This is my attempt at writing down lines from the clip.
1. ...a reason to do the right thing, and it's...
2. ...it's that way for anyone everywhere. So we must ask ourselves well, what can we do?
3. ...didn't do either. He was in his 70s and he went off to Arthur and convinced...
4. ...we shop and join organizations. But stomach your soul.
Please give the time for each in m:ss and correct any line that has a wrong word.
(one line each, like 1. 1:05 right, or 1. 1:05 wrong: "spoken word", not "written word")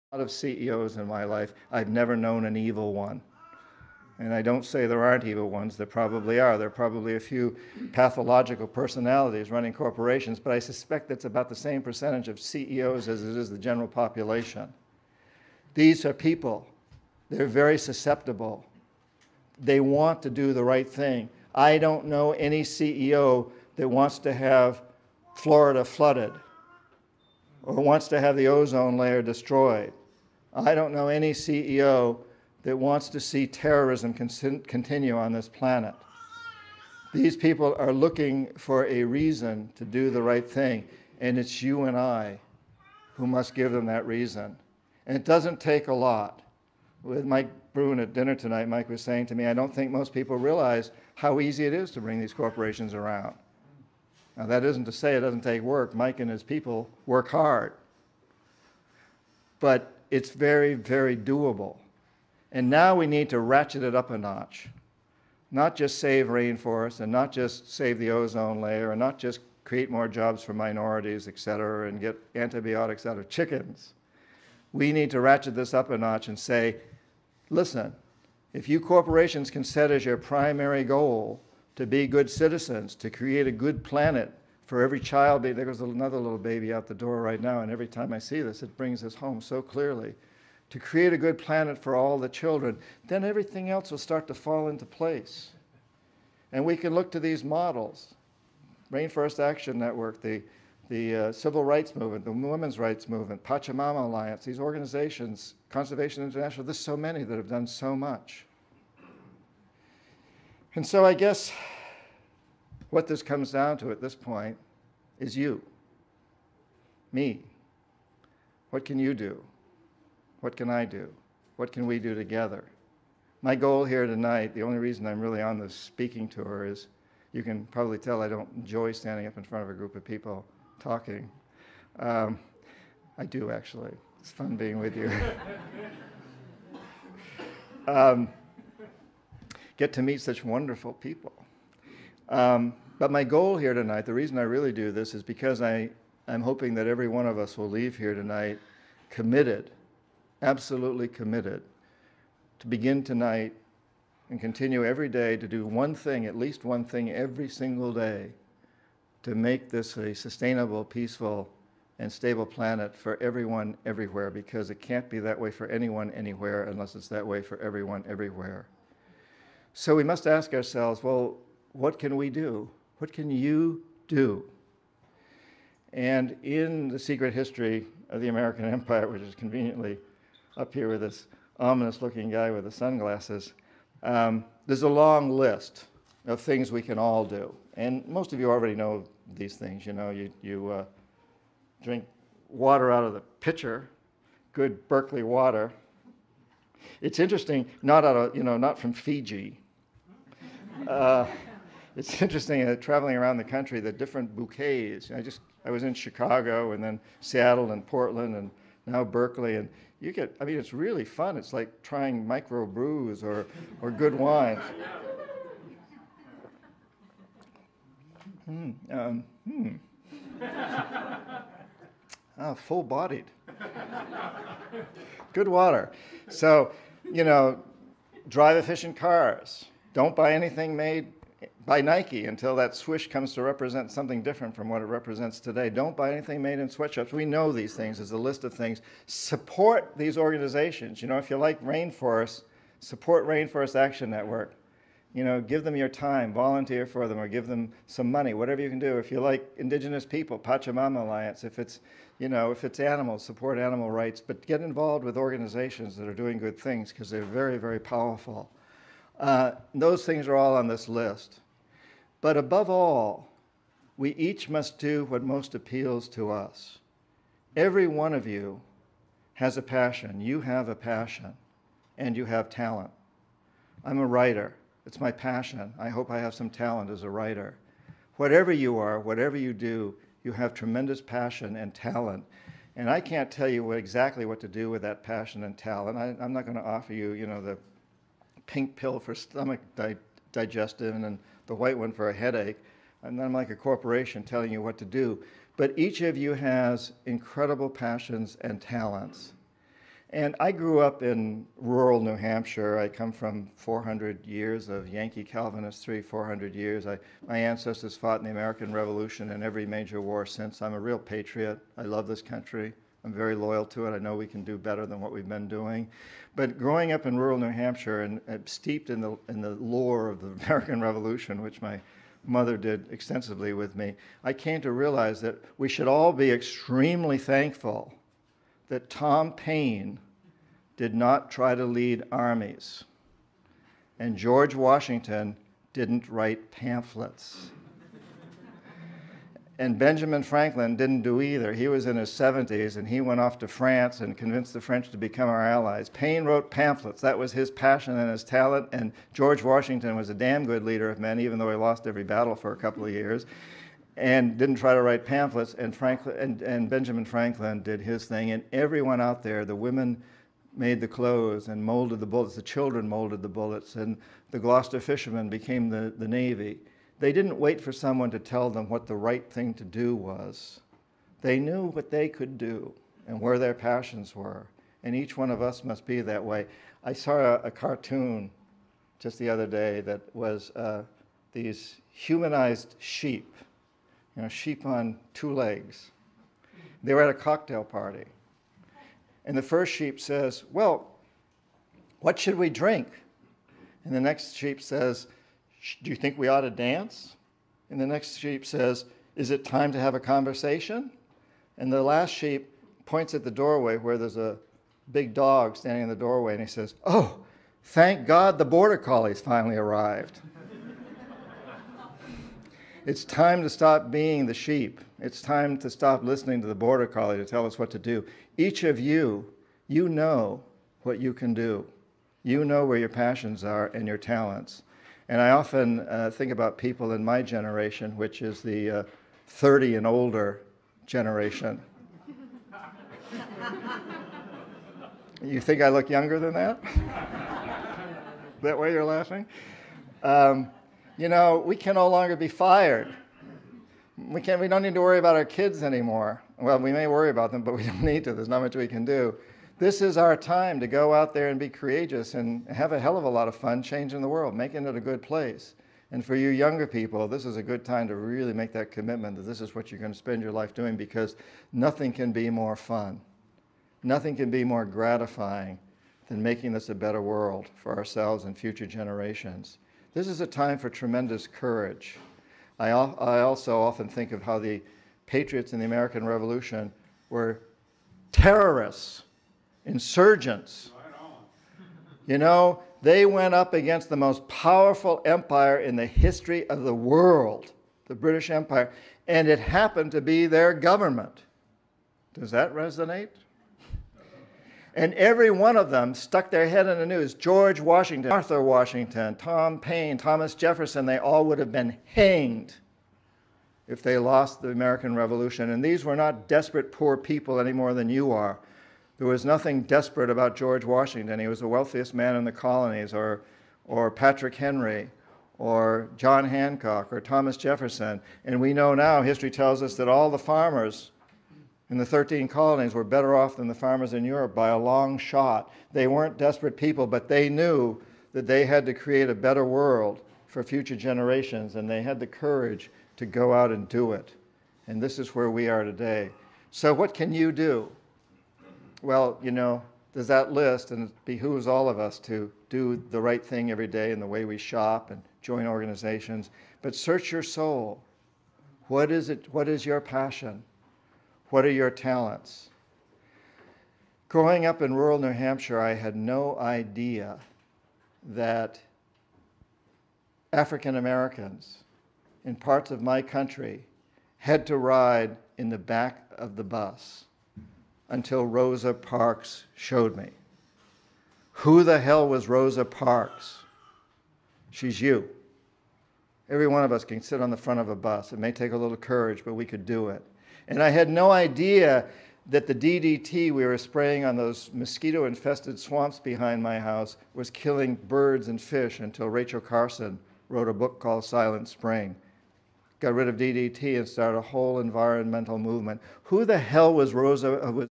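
1. 0:38 right
2. 2:46 wrong: "everyone", not "anyone"
3. 5:40 wrong: "France", not "Arthur"
4. 9:04 wrong: "search", not "stomach".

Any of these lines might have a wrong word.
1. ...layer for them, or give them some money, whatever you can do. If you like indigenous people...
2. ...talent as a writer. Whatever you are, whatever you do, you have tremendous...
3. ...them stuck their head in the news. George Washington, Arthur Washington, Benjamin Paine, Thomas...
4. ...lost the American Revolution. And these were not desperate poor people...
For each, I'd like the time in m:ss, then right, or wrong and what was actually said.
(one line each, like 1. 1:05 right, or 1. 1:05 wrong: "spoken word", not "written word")
1. 4:06 wrong: "volunteer", not "layer"
2. 4:36 right
3. 8:15 wrong: "Tom", not "Benjamin"
4. 8:23 right.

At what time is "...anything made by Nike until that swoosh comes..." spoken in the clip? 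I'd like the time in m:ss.
3:50.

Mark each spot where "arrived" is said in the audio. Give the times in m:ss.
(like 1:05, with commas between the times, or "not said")
6:49.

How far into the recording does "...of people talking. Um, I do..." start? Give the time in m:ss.
2:09.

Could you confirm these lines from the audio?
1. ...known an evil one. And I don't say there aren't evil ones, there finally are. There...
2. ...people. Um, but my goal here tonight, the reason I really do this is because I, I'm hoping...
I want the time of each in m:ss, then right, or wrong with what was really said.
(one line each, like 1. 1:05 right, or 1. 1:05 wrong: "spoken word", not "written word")
1. 0:02 wrong: "probably", not "finally"
2. 2:20 right.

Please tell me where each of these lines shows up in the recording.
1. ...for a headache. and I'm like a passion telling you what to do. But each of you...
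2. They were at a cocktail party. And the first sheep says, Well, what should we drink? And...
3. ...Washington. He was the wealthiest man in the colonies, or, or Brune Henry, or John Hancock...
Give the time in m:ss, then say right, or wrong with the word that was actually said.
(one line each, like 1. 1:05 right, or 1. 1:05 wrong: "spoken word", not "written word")
1. 4:51 wrong: "corporation", not "passion"
2. 6:26 right
3. 8:30 wrong: "Patrick", not "Brune".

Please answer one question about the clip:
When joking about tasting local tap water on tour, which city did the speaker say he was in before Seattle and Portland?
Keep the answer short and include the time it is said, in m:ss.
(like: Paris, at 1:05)
Chicago, at 3:25.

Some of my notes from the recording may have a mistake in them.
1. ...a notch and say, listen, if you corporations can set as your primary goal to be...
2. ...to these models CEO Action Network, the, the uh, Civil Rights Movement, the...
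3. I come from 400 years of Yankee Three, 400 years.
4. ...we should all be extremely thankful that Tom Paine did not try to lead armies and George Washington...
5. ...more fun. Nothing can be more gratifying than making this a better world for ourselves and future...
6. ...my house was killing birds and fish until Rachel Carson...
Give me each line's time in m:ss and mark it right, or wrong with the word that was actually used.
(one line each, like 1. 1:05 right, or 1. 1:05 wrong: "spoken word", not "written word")
1. 1:15 right
2. 1:37 wrong: "Rainforest", not "CEO"
3. 5:02 right
4. 5:25 right
5. 7:42 right
6. 9:46 right.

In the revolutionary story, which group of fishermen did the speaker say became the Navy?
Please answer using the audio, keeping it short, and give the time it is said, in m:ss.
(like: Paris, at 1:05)
Gloucester fishermen, at 6:04.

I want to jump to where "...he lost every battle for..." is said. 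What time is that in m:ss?
5:51.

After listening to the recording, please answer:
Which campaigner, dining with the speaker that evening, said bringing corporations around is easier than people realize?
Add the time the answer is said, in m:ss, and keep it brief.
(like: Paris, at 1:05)
Mike Brune, at 0:47.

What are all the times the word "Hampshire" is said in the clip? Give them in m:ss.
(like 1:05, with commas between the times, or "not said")
5:02, 5:17, 9:15.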